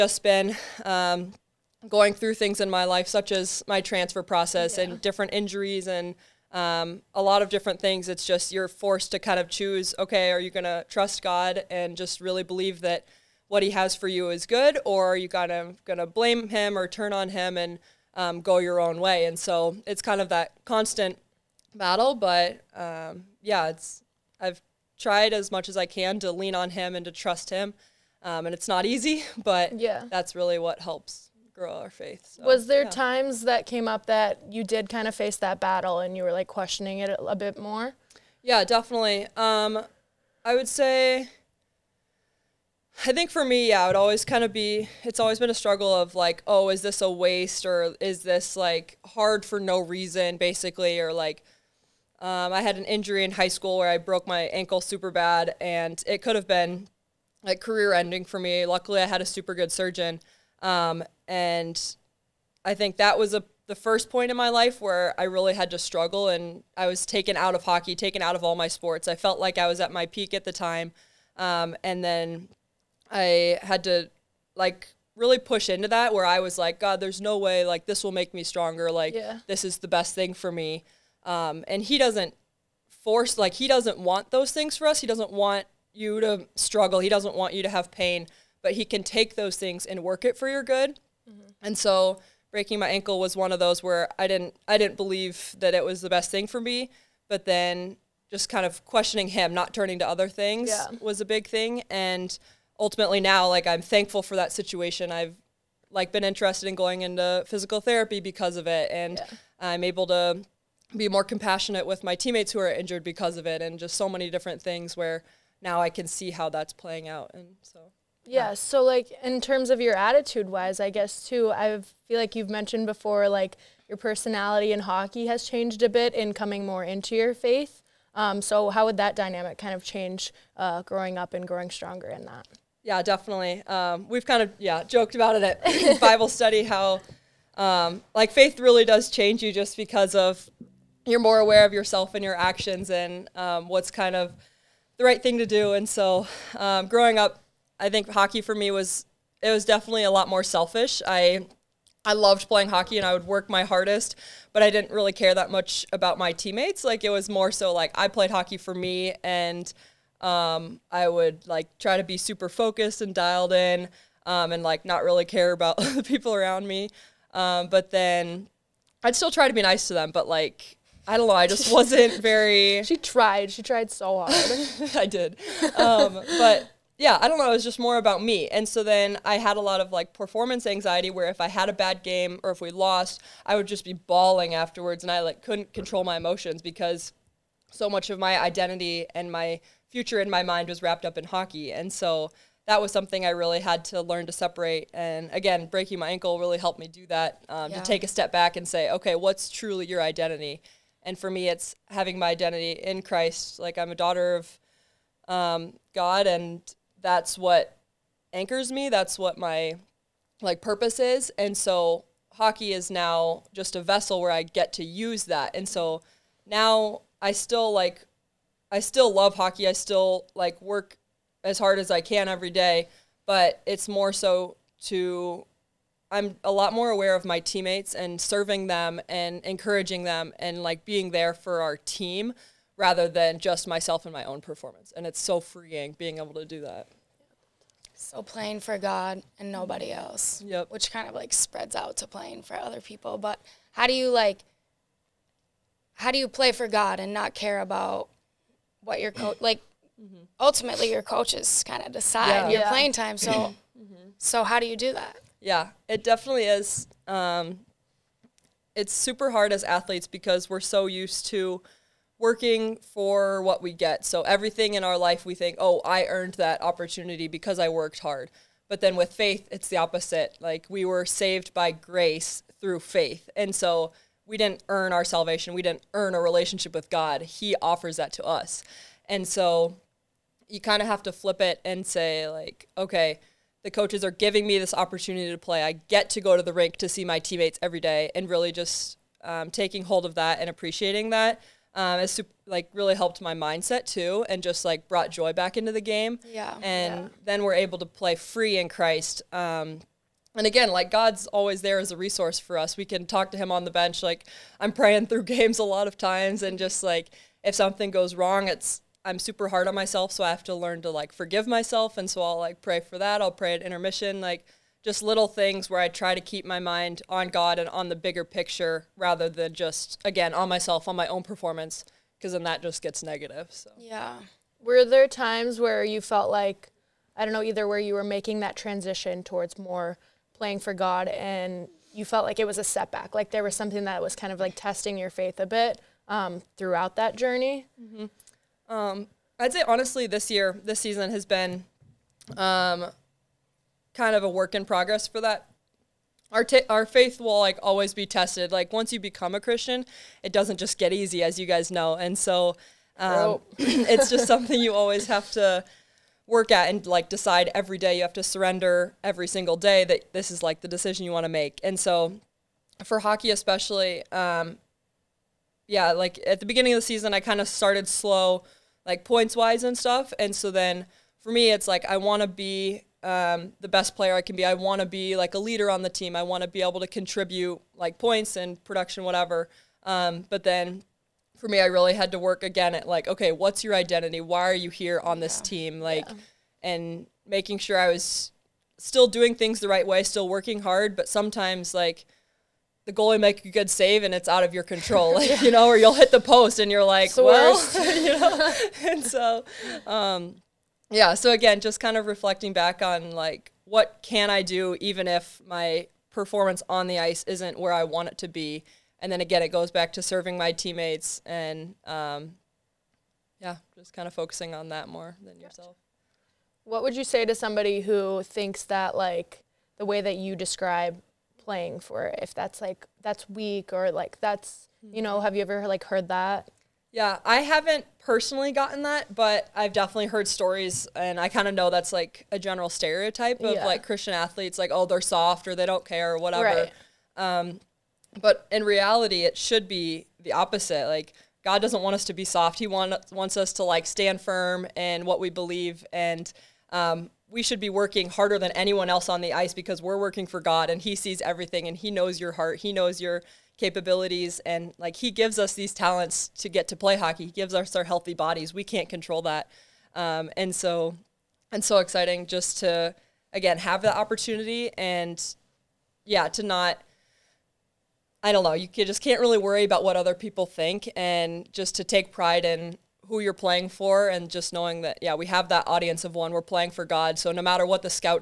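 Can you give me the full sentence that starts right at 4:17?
Um, it's super hard as athletes because we're so used to working for what we get.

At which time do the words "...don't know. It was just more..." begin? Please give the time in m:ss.
2:57.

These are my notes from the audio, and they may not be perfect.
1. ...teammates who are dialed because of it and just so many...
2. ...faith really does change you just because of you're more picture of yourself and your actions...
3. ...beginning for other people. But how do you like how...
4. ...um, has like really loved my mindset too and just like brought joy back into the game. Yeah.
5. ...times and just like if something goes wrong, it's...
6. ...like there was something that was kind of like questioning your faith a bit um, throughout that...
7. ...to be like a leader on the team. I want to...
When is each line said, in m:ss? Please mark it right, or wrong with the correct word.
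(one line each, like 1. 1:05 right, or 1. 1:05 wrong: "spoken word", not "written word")
1. 1:52 wrong: "injured", not "dialed"
2. 2:18 wrong: "aware", not "picture"
3. 4:02 wrong: "playing", not "beginning"
4. 4:51 wrong: "helped", not "loved"
5. 5:05 right
6. 5:33 wrong: "testing", not "questioning"
7. 6:14 right.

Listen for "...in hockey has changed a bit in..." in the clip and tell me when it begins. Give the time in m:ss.
2:04.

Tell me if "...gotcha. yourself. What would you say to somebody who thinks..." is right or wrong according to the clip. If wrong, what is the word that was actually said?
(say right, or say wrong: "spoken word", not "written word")
right.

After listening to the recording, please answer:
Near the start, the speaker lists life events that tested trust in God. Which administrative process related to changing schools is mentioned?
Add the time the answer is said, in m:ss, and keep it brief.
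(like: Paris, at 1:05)
transfer process, at 0:03.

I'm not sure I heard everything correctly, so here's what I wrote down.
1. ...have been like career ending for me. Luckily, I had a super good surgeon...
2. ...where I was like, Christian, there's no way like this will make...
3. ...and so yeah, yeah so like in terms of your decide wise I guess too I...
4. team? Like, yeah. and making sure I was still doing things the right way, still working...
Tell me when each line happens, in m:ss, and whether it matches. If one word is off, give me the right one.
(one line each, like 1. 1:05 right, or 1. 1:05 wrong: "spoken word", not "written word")
1. 0:56 right
2. 1:16 wrong: "God", not "Christian"
3. 1:57 wrong: "attitude", not "decide"
4. 6:25 right.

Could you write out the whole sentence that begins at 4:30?
Like we were saved by grace through faith.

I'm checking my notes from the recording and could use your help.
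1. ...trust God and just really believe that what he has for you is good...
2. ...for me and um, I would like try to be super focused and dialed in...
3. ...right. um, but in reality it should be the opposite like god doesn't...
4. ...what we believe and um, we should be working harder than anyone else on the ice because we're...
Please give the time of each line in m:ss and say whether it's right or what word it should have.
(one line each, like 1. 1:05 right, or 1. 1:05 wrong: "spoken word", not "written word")
1. 0:10 right
2. 2:38 right
3. 7:16 right
4. 7:25 right.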